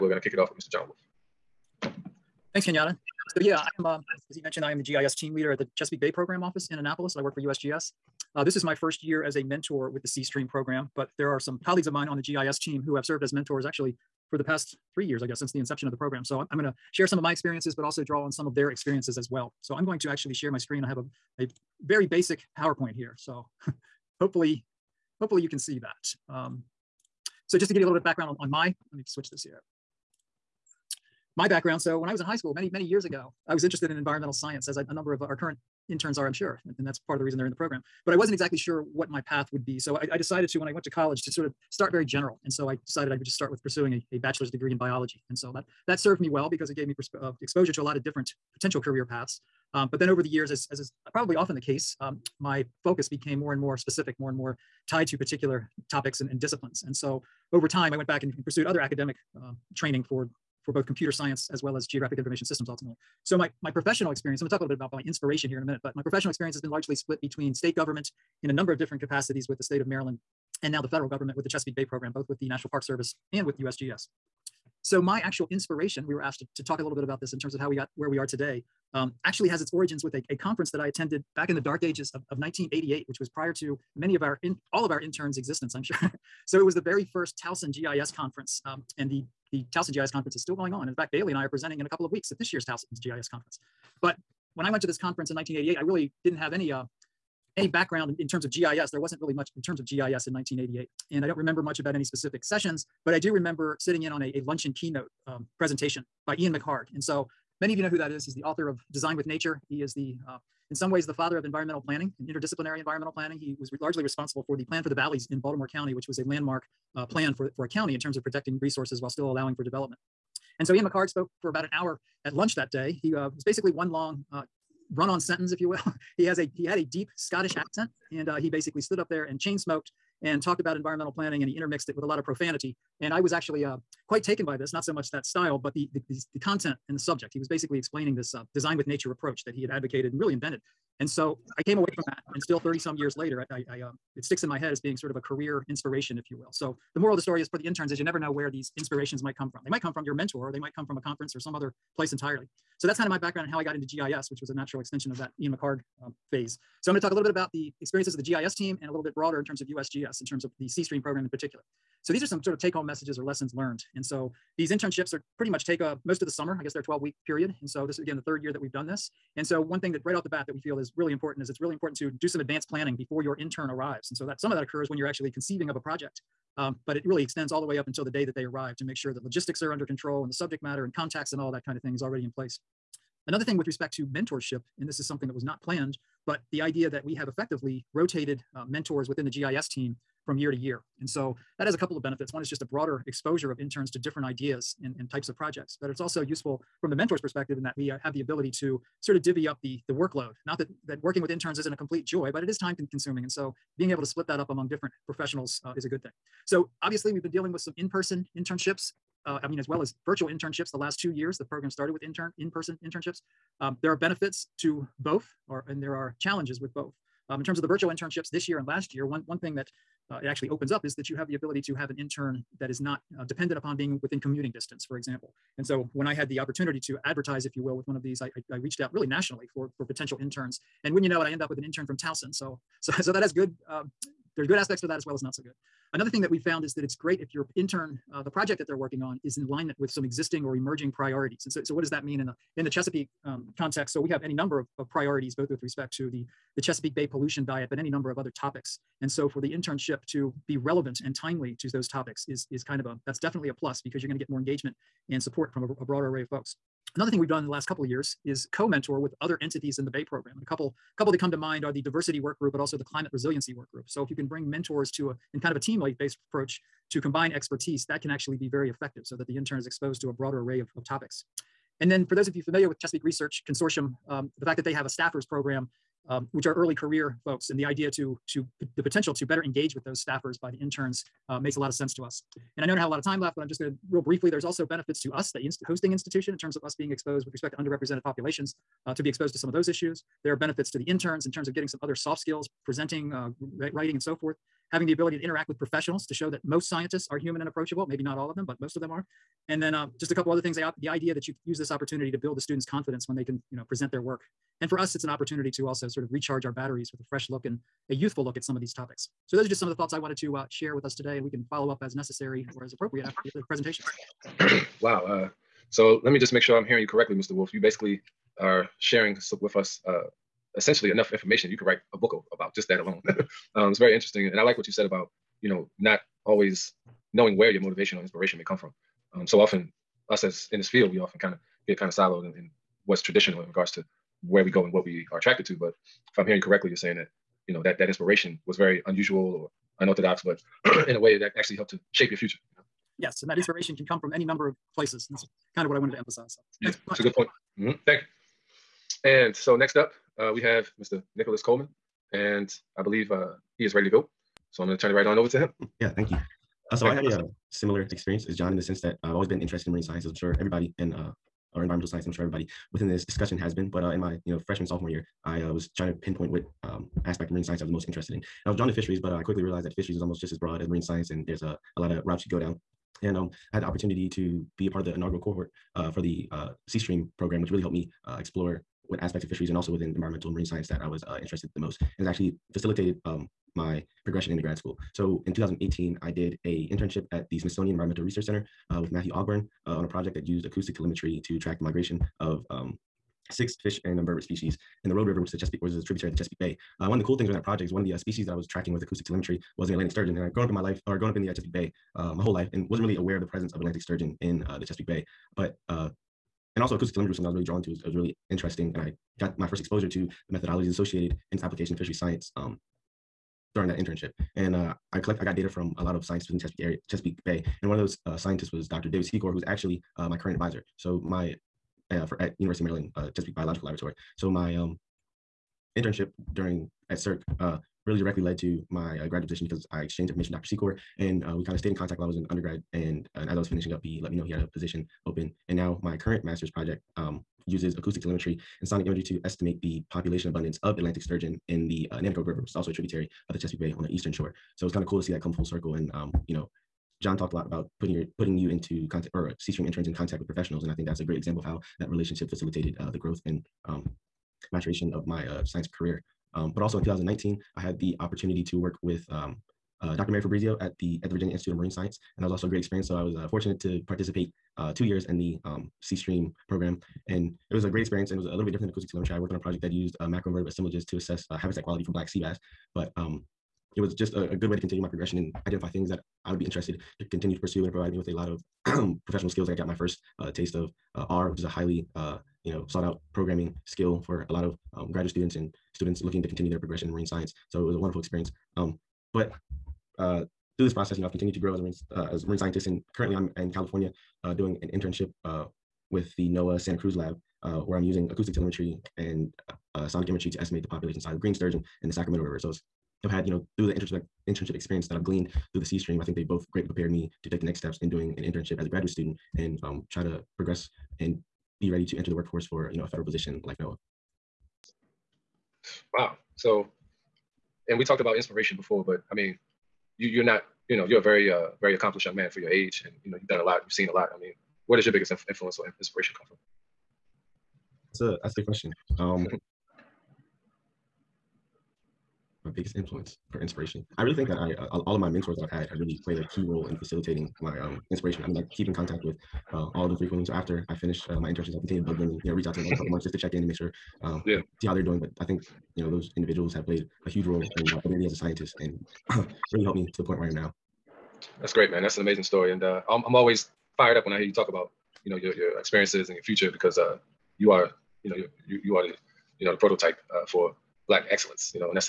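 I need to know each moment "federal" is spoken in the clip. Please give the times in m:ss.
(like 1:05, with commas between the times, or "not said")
1:10, 8:32.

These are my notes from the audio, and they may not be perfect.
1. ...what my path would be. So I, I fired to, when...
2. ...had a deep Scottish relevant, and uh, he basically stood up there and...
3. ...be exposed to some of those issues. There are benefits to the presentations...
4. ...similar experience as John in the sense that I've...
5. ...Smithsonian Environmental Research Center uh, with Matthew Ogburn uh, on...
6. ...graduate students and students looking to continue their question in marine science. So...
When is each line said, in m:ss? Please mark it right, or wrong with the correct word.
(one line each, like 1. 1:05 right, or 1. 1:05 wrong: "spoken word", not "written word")
1. 0:38 wrong: "decided", not "fired"
2. 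2:06 wrong: "accent", not "relevant"
3. 4:49 wrong: "interns", not "presentations"
4. 5:57 right
5. 6:27 right
6. 8:04 wrong: "progression", not "question".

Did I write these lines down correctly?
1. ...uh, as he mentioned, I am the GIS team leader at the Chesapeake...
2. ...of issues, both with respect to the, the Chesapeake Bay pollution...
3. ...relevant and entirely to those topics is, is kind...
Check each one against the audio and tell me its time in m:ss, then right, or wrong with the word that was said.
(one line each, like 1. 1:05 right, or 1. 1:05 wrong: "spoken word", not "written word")
1. 0:03 right
2. 4:04 wrong: "priorities", not "issues"
3. 4:10 wrong: "timely", not "entirely".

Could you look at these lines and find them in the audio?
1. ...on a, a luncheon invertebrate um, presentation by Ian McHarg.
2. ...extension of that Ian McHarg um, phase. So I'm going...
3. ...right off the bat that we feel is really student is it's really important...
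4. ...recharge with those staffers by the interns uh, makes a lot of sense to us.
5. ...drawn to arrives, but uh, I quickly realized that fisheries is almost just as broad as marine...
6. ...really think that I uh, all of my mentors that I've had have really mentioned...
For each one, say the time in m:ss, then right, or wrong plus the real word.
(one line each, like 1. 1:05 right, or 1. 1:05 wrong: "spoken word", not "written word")
1. 1:44 wrong: "keynote", not "invertebrate"
2. 2:34 right
3. 2:50 wrong: "important", not "student"
4. 4:39 wrong: "engage", not "recharge"
5. 6:08 wrong: "fisheries", not "arrives"
6. 8:54 wrong: "played", not "mentioned".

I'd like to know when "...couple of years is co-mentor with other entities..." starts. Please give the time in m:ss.
4:17.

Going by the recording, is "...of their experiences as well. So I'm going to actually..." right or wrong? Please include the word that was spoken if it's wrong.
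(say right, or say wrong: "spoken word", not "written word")
right.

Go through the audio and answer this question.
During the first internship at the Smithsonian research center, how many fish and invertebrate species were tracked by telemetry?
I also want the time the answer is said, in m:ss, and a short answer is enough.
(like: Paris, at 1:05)
6, at 6:33.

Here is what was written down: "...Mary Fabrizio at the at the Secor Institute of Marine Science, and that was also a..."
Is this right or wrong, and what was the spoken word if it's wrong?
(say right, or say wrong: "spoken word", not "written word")
wrong: "Virginia", not "Secor".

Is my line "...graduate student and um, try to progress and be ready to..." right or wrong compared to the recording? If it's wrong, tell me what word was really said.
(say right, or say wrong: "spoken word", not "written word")
right.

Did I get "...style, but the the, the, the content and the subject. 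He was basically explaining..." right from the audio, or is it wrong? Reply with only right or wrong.
right.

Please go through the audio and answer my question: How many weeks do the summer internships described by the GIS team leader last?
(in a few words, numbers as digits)
12.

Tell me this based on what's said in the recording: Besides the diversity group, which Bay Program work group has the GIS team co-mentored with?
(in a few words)
climate resiliency work group.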